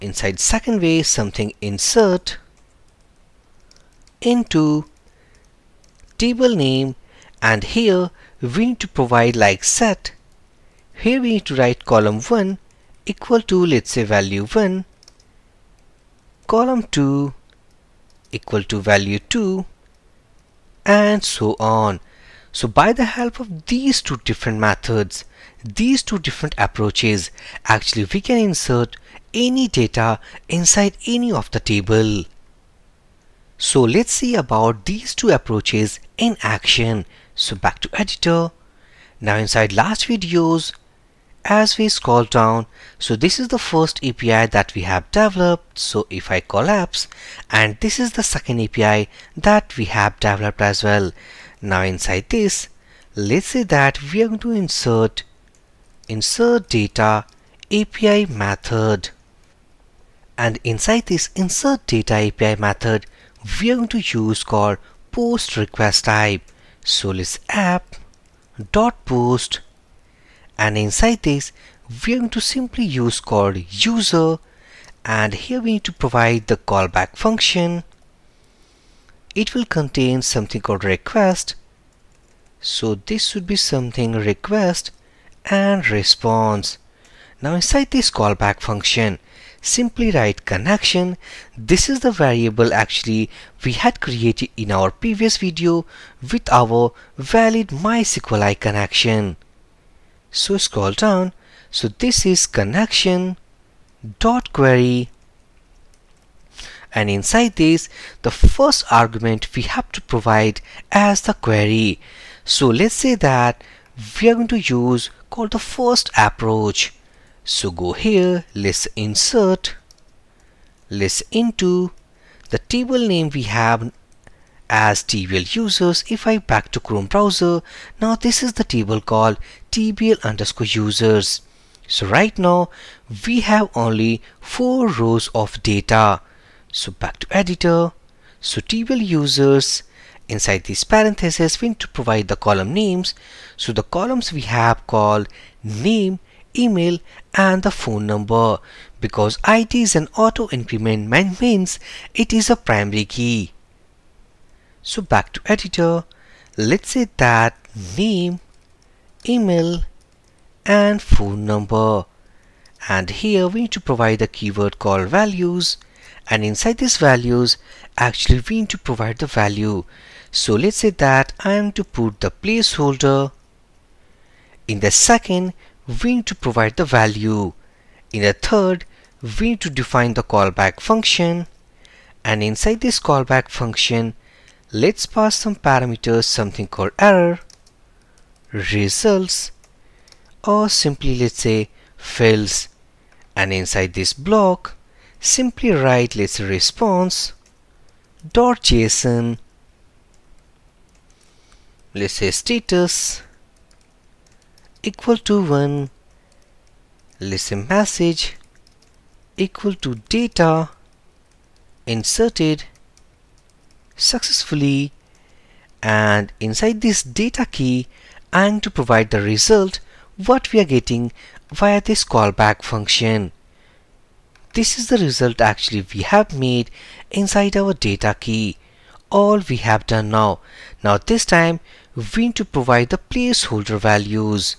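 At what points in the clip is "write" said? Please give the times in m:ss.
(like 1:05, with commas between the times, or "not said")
0:11, 1:30, 3:15.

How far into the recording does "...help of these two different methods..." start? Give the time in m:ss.
0:23.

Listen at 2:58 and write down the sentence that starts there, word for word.
In the third, we need to define the callback function.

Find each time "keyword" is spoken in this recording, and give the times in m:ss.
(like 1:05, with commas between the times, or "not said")
2:44.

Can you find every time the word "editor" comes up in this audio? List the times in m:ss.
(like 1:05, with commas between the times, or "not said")
0:37, 2:17, 2:35.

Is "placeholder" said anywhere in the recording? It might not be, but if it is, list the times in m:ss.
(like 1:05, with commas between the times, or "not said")
2:52, 3:53.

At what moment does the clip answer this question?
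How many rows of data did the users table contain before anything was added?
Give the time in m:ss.
2:14.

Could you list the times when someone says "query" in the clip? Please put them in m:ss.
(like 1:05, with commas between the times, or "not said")
1:44, 1:51.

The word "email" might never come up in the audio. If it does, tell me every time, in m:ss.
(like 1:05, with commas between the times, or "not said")
2:26, 2:39.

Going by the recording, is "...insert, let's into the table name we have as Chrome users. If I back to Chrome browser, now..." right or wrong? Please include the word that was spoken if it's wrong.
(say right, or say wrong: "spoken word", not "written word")
wrong: "TBL", not "Chrome".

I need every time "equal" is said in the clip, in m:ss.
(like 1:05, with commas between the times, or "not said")
0:13, 0:18, 3:24, 3:29.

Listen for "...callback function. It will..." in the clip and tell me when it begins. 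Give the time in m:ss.
1:16.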